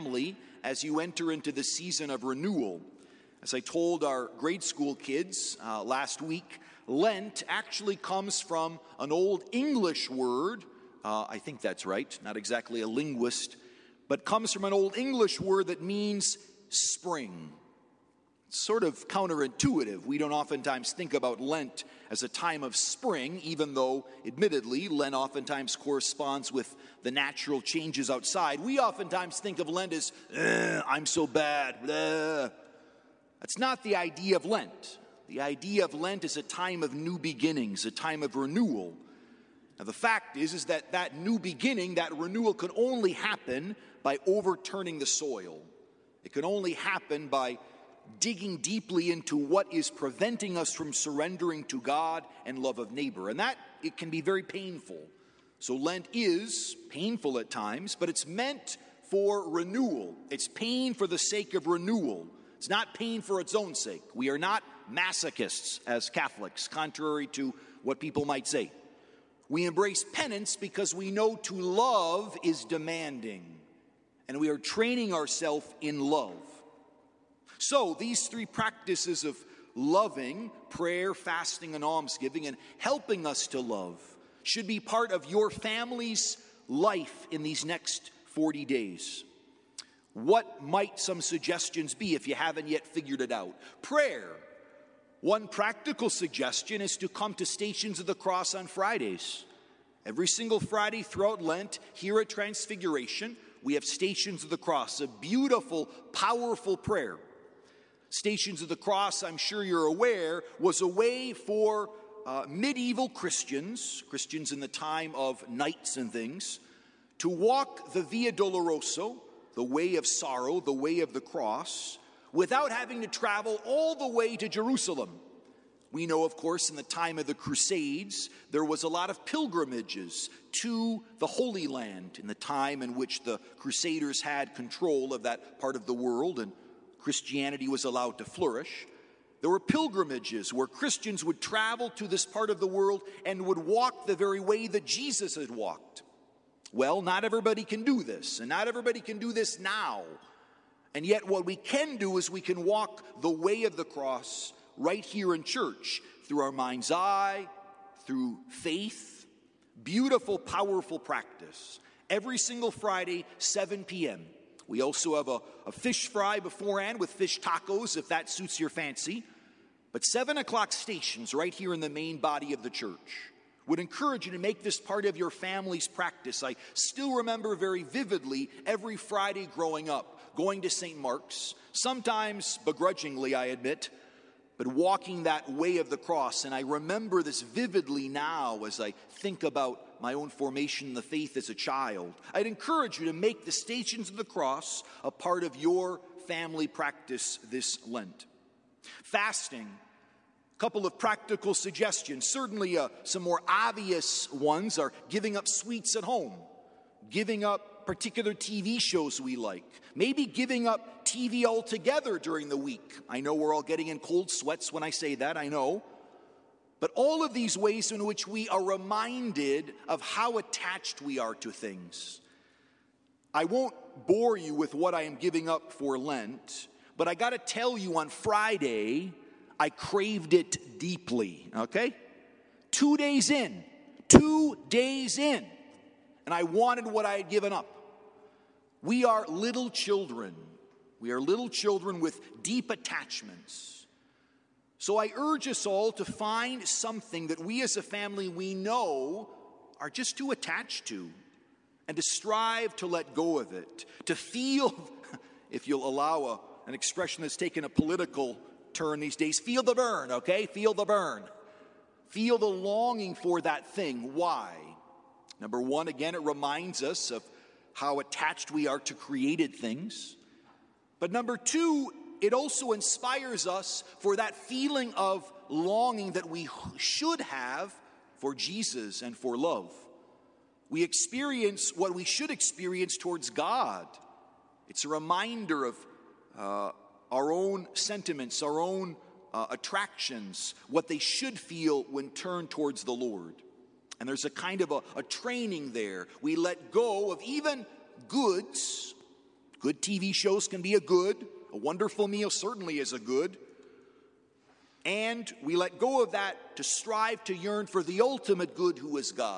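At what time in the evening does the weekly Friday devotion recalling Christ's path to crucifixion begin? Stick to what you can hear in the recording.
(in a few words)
7 p.m.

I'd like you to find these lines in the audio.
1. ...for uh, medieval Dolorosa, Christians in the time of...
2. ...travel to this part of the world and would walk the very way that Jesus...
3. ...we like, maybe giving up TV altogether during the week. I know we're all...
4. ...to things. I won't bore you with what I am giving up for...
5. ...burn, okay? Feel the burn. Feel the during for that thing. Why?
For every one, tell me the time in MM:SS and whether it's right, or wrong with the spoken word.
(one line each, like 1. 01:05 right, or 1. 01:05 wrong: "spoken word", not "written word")
1. 01:51 wrong: "Christians", not "Dolorosa"
2. 02:21 right
3. 03:29 right
4. 03:41 right
5. 04:19 wrong: "longing", not "during".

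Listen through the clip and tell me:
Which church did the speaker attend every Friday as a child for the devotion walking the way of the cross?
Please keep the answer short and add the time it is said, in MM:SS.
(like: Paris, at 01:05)
St. Mark's, at 03:00.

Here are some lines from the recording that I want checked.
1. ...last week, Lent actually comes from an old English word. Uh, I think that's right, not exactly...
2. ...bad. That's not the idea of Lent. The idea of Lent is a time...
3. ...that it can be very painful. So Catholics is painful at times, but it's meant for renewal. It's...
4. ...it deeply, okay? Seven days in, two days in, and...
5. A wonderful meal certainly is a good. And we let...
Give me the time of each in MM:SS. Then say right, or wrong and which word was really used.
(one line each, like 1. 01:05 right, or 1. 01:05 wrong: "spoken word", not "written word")
1. 00:05 right
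2. 00:31 right
3. 00:53 wrong: "Lent", not "Catholics"
4. 03:50 wrong: "Two", not "Seven"
5. 05:01 right.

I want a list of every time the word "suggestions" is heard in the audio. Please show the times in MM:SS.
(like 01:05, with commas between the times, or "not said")
01:31, 01:36, 03:21.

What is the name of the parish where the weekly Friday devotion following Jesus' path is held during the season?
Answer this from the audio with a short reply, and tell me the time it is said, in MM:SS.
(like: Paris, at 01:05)
Transfiguration, at 01:42.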